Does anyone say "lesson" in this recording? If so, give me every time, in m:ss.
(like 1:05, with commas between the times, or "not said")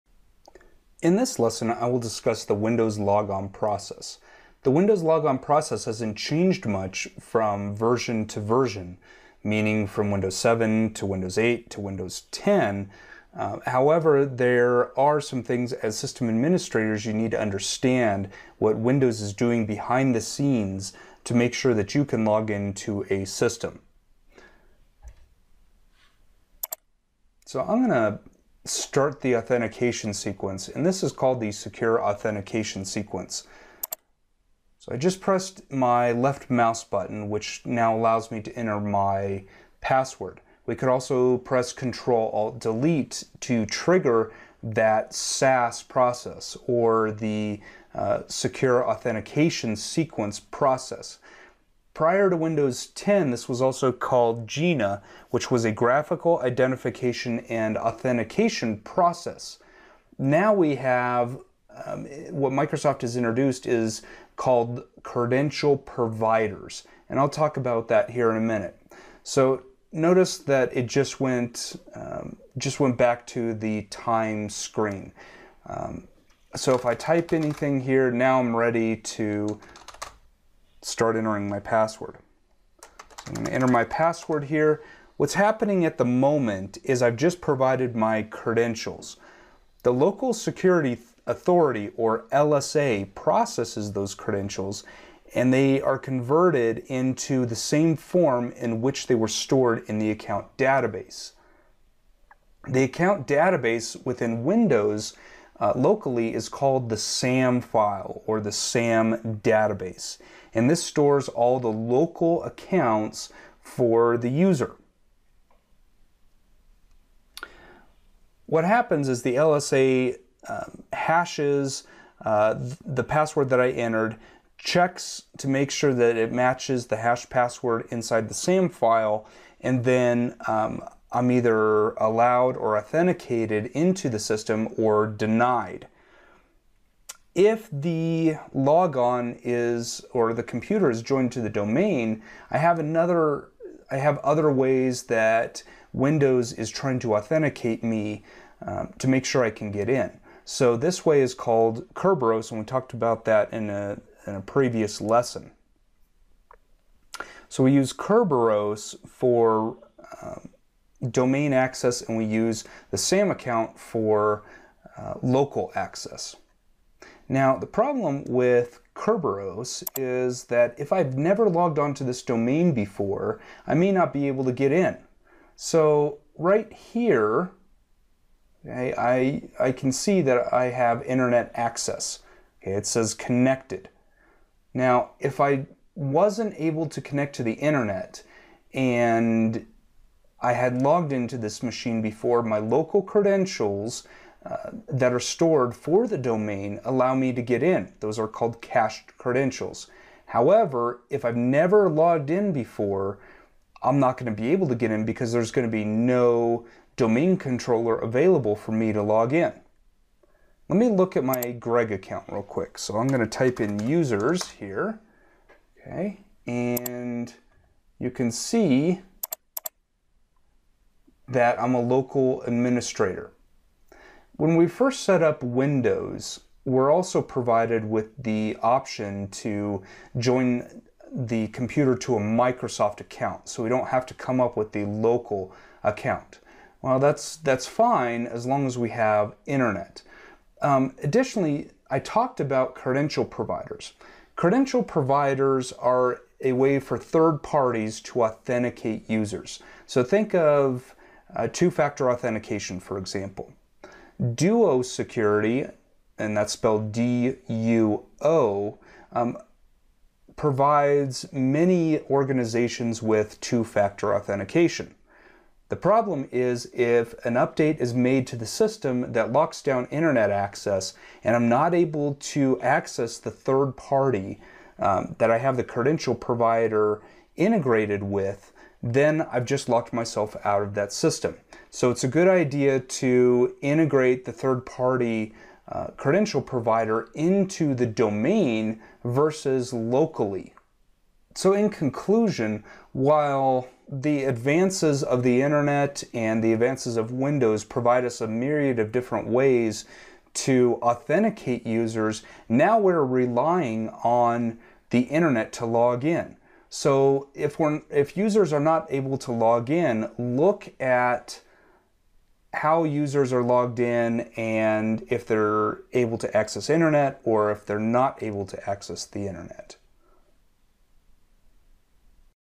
0:01, 2:34.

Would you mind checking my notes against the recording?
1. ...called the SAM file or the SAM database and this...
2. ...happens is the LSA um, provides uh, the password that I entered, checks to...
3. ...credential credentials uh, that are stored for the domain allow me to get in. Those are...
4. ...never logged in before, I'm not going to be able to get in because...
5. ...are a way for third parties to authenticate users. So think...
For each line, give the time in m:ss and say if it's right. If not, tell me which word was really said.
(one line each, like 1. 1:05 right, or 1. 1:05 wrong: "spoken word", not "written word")
1. 1:46 right
2. 1:58 wrong: "hashes", not "provides"
3. 3:12 wrong: "local", not "credential"
4. 3:21 right
5. 4:05 right.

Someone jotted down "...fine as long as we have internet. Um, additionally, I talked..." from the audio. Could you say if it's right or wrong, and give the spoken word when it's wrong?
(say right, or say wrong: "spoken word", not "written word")
right.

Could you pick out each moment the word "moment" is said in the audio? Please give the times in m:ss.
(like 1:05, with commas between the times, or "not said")
1:26.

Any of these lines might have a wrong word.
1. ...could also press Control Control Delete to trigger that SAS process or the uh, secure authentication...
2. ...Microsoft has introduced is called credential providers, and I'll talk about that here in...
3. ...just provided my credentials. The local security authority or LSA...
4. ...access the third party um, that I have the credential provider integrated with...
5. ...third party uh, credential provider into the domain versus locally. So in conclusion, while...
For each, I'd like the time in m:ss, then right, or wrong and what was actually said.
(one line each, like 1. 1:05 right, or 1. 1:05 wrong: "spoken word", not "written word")
1. 0:40 wrong: "Alt", not "Control"
2. 1:02 right
3. 1:27 right
4. 4:32 right
5. 4:44 right.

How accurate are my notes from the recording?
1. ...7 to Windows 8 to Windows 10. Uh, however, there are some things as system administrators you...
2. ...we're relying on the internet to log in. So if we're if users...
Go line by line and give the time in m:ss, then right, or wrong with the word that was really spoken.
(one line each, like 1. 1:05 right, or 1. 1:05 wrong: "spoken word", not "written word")
1. 0:10 right
2. 5:02 right.